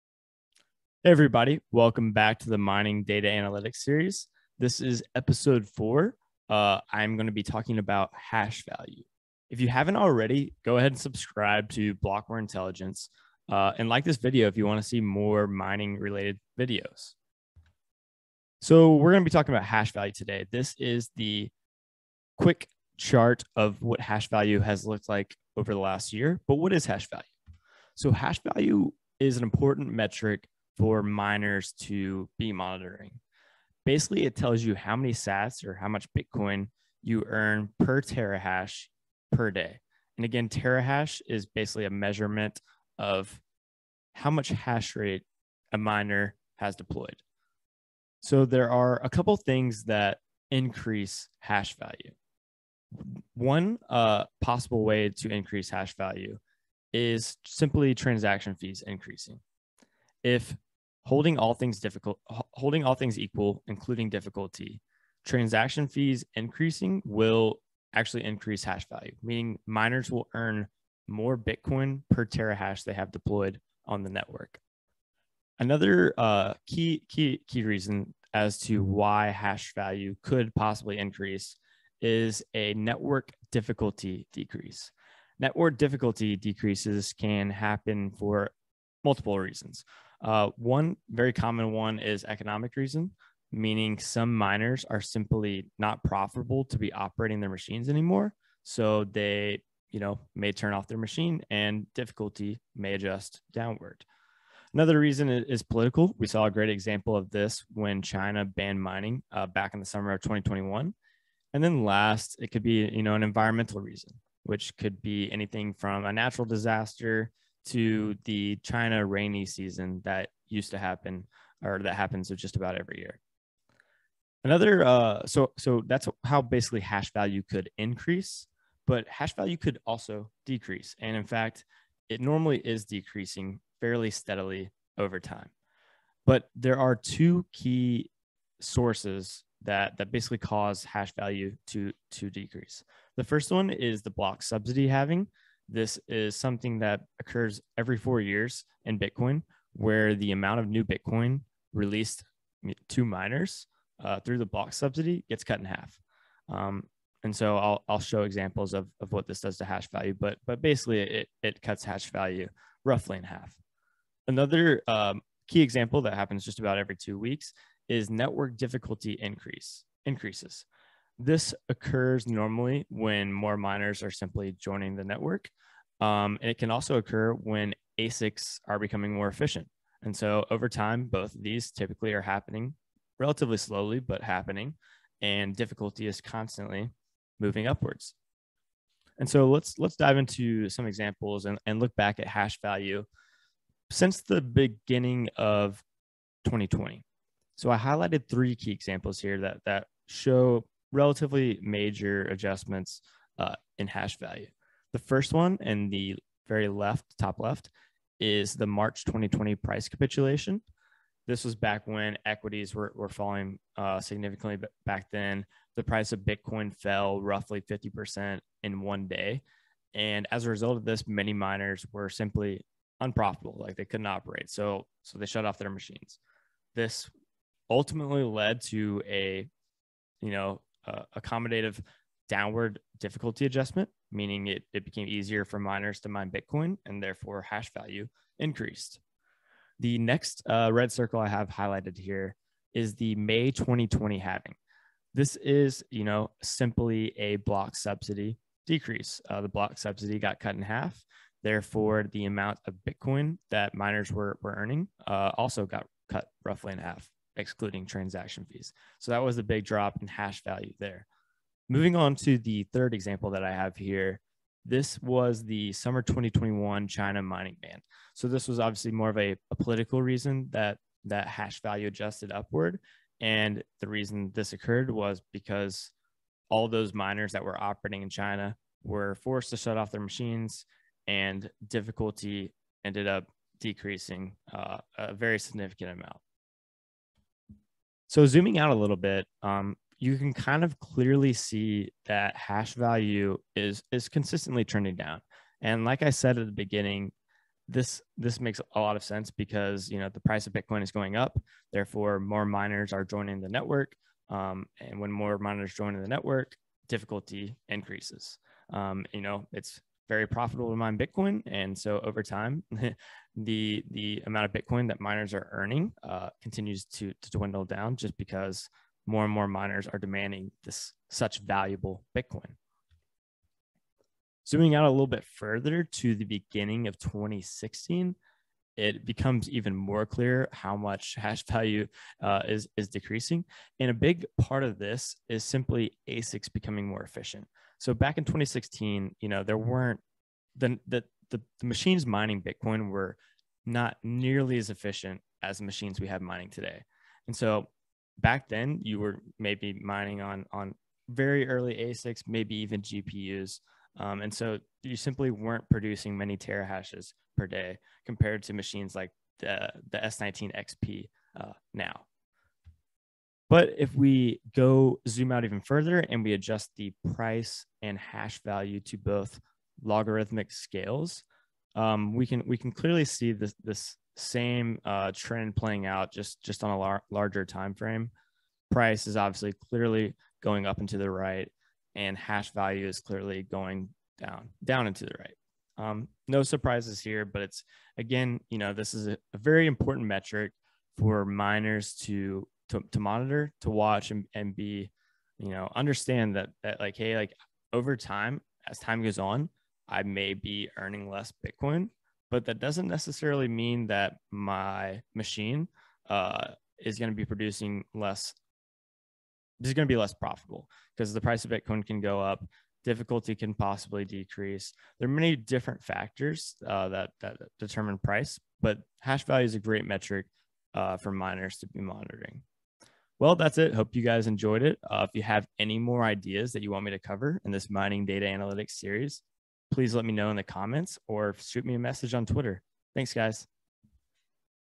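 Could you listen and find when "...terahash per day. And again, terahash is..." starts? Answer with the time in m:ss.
0:38.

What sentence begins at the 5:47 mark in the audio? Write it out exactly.
And so back then you were maybe mining on on very early ASICs, maybe even GPUs.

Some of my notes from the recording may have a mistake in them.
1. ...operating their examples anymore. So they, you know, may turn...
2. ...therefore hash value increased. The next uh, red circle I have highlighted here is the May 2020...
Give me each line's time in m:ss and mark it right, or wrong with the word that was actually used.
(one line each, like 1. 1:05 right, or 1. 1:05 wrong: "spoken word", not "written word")
1. 1:36 wrong: "machines", not "examples"
2. 3:57 right.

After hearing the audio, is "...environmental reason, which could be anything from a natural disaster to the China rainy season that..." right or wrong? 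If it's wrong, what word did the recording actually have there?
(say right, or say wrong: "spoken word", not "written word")
right.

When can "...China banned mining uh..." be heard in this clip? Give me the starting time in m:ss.
1:48.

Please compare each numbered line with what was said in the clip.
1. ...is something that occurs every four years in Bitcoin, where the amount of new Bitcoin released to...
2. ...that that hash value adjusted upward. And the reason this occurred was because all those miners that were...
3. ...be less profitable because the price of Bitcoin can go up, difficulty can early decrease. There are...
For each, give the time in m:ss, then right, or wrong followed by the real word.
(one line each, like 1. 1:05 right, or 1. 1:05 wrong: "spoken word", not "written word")
1. 2:26 right
2. 4:30 right
3. 6:49 wrong: "possibly", not "early".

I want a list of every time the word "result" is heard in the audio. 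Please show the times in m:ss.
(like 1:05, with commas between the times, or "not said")
3:40.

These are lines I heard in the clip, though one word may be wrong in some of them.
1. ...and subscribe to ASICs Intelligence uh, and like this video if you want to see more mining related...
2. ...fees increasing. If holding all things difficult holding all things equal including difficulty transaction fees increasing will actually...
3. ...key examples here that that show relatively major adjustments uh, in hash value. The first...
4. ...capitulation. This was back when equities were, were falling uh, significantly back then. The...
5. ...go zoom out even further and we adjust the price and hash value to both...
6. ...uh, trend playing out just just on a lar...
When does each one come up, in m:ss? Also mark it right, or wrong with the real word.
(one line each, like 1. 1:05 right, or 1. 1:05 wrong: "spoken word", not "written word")
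1. 0:10 wrong: "Blockware", not "ASICs"
2. 0:58 right
3. 3:18 right
4. 3:29 right
5. 6:04 right
6. 6:14 right.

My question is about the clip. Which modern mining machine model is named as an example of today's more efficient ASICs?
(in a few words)
S19 XP.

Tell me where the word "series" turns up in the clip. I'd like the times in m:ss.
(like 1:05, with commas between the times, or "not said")
0:03, 7:08.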